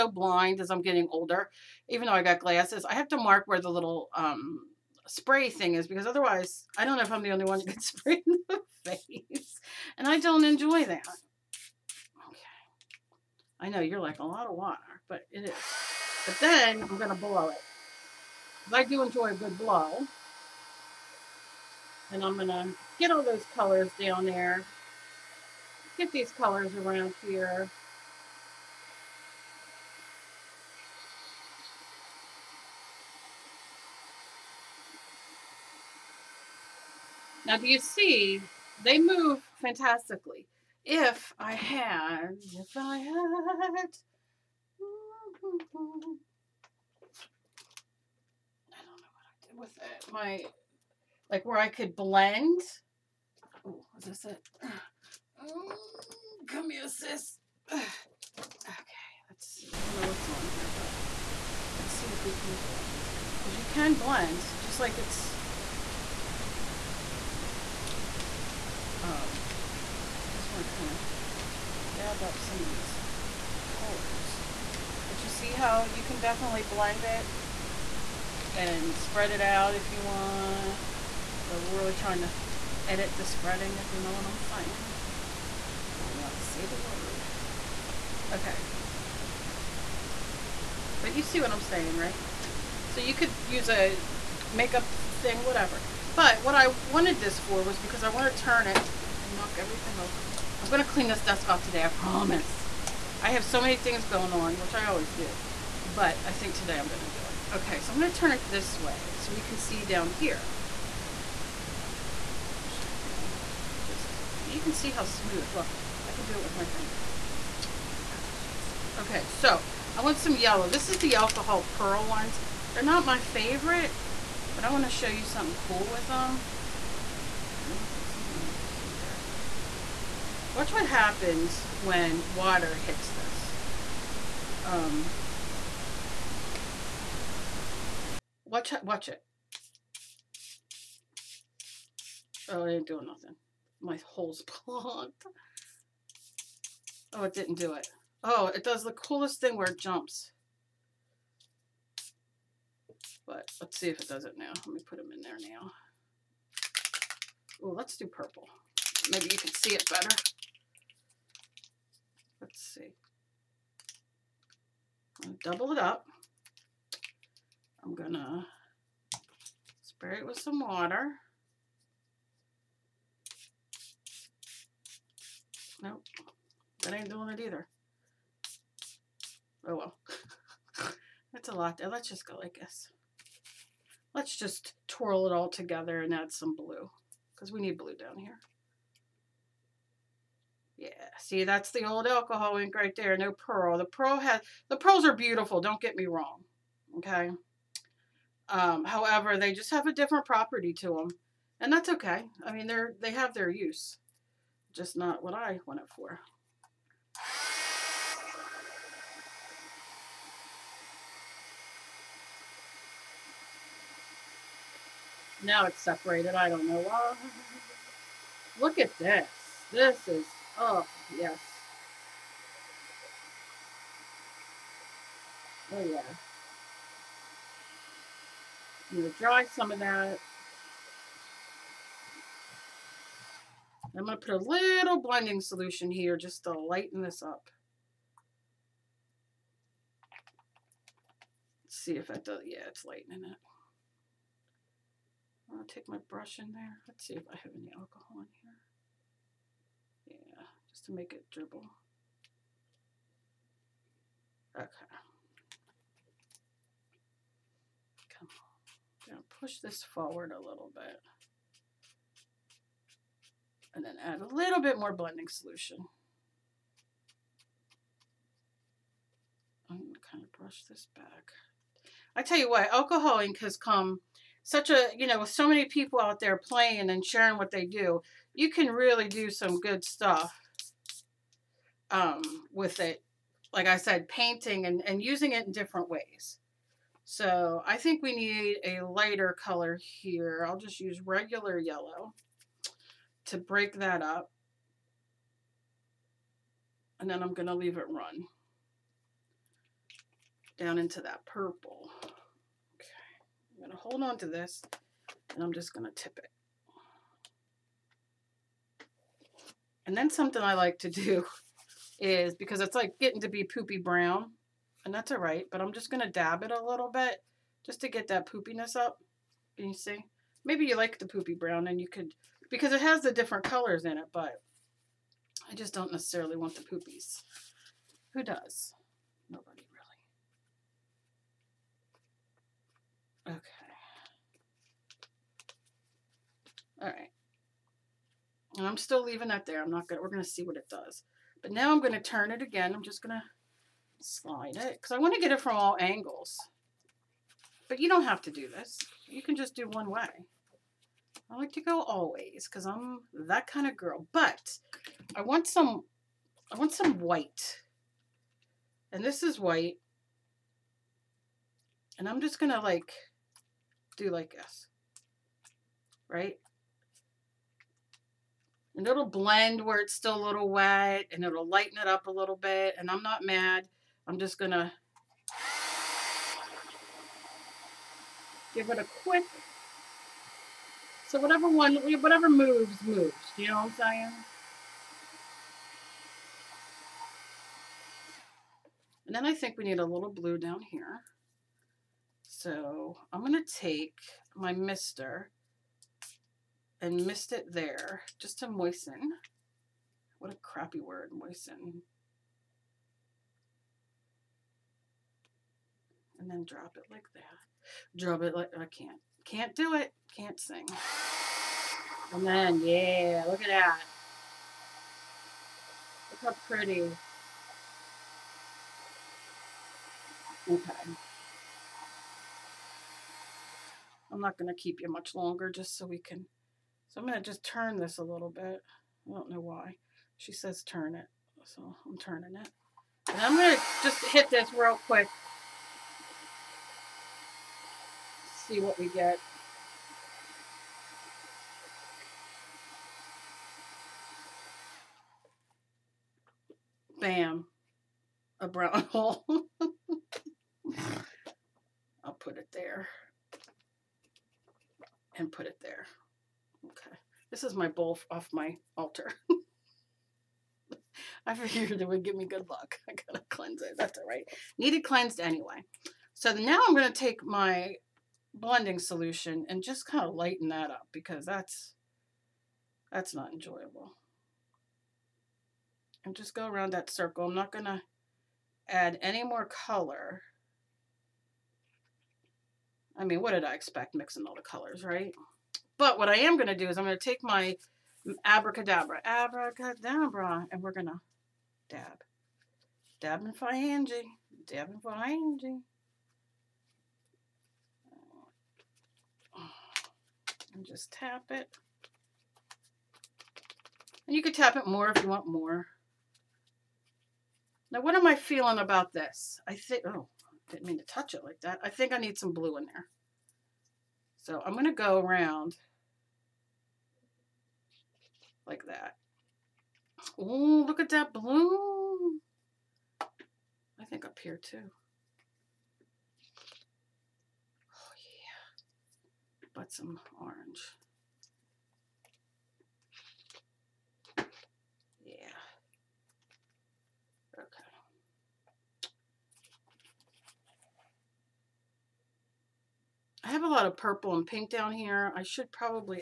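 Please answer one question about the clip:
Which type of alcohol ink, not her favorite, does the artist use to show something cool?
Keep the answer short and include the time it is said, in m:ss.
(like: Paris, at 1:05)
alcohol pearl, at 2:01.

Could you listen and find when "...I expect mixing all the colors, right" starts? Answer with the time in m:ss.
8:03.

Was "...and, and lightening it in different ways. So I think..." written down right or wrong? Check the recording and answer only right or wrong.
wrong.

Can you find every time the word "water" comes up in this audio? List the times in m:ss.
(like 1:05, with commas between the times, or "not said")
0:14, 2:12, 2:50.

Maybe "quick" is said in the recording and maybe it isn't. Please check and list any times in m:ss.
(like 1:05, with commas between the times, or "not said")
6:19, 7:14.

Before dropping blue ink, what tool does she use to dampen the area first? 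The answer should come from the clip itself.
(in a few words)
mister.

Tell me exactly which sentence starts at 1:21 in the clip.
We're really trying to edit the spreading, if you know what I'm saying.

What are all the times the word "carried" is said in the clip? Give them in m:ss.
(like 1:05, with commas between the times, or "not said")
not said.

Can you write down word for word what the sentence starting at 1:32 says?
So you could use a makeup thing, whatever.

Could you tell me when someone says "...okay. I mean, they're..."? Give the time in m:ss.
3:21.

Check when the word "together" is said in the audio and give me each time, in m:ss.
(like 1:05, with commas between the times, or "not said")
3:05.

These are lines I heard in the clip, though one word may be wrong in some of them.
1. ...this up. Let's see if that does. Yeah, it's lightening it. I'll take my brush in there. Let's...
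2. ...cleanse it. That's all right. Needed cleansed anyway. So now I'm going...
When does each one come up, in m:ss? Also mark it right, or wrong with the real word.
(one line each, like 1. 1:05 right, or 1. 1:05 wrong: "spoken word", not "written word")
1. 3:57 right
2. 7:43 right.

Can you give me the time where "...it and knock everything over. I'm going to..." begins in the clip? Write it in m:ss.
1:38.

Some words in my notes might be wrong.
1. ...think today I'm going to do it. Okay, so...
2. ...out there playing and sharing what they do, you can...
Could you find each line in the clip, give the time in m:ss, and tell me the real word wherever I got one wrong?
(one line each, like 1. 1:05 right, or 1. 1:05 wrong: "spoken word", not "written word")
1. 1:46 right
2. 4:35 right.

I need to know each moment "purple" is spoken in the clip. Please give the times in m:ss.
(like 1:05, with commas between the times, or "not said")
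2:38, 5:01, 9:03.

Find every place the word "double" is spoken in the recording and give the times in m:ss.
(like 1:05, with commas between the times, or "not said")
2:45.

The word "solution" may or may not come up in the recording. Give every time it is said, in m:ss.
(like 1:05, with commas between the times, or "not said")
3:55, 4:25, 7:48.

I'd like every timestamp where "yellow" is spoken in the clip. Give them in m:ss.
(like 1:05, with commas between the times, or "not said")
2:00, 4:51.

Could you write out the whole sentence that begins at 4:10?
Yeah, just to make it dribble.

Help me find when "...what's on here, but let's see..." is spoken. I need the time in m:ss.
1:00.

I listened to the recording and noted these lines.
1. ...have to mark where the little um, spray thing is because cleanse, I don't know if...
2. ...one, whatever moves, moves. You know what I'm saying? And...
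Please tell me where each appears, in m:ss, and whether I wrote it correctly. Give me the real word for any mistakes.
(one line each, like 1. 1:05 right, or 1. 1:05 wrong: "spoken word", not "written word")
1. 0:02 wrong: "otherwise", not "cleanse"
2. 6:21 right.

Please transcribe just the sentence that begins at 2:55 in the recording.
Nope, that ain't doing it either.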